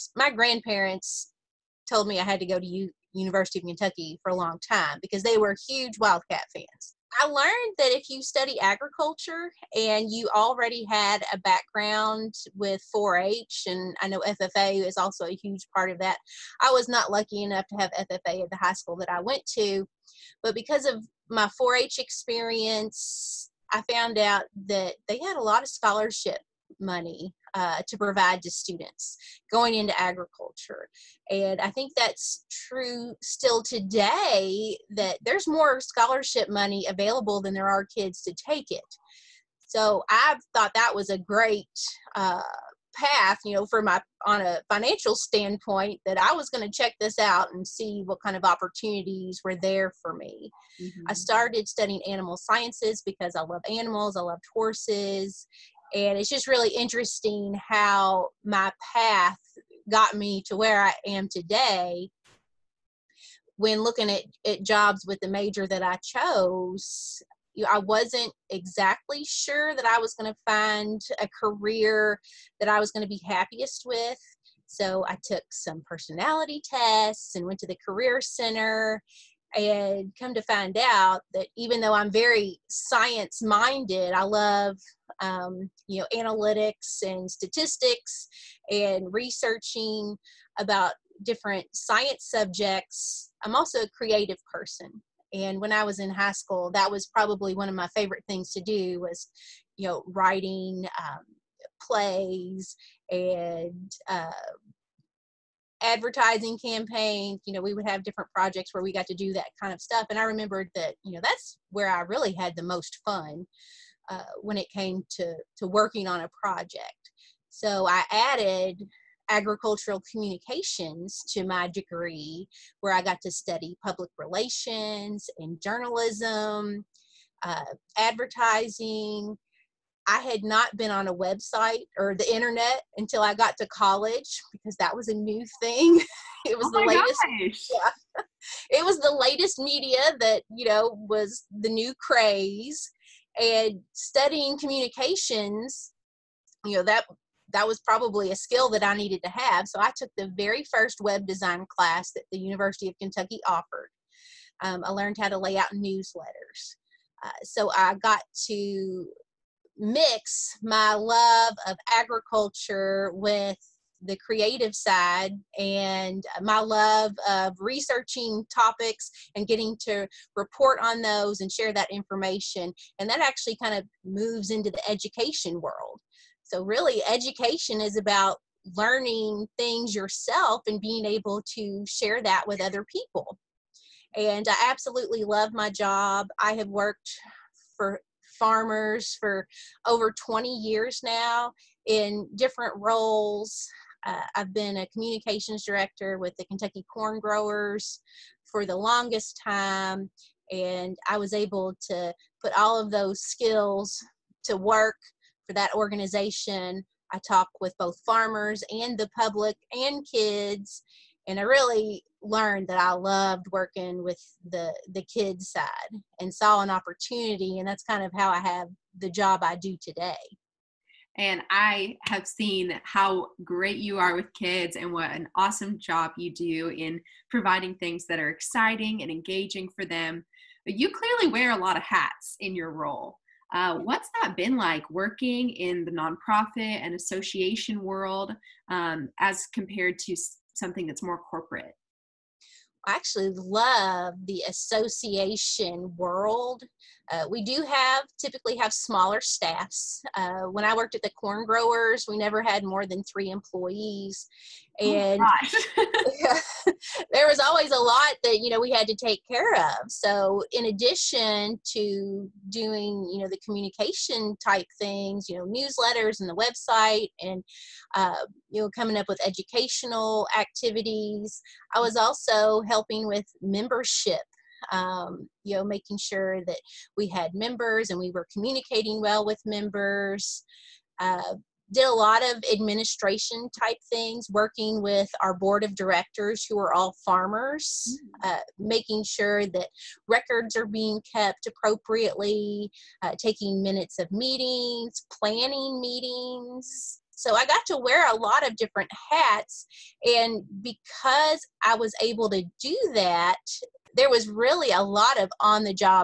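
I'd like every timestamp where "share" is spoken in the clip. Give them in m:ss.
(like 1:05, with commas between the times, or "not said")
2:51, 3:01.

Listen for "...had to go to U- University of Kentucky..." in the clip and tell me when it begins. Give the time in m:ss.
0:02.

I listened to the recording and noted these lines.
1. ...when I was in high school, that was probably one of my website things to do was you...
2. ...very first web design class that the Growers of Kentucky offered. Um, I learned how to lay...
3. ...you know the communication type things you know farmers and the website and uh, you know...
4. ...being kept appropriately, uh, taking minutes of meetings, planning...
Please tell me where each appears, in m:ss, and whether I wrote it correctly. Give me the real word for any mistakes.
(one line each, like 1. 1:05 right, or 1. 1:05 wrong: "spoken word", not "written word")
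1. 1:35 wrong: "favorite", not "website"
2. 2:30 wrong: "University", not "Growers"
3. 4:23 wrong: "newsletters", not "farmers"
4. 4:50 right.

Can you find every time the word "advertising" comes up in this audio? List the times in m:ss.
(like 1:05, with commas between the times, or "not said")
1:45, 2:07.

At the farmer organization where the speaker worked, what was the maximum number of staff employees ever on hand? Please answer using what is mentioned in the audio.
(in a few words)
3.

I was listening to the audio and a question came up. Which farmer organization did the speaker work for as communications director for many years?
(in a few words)
Kentucky Corn Growers.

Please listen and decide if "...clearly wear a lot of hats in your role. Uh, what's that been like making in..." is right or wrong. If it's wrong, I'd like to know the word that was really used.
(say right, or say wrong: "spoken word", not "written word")
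wrong: "working", not "making".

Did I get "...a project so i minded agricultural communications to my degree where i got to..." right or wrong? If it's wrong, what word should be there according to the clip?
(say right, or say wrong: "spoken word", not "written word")
wrong: "added", not "minded".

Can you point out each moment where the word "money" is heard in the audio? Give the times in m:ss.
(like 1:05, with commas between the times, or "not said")
0:26, 0:36.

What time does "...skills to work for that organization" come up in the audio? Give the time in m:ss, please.
3:23.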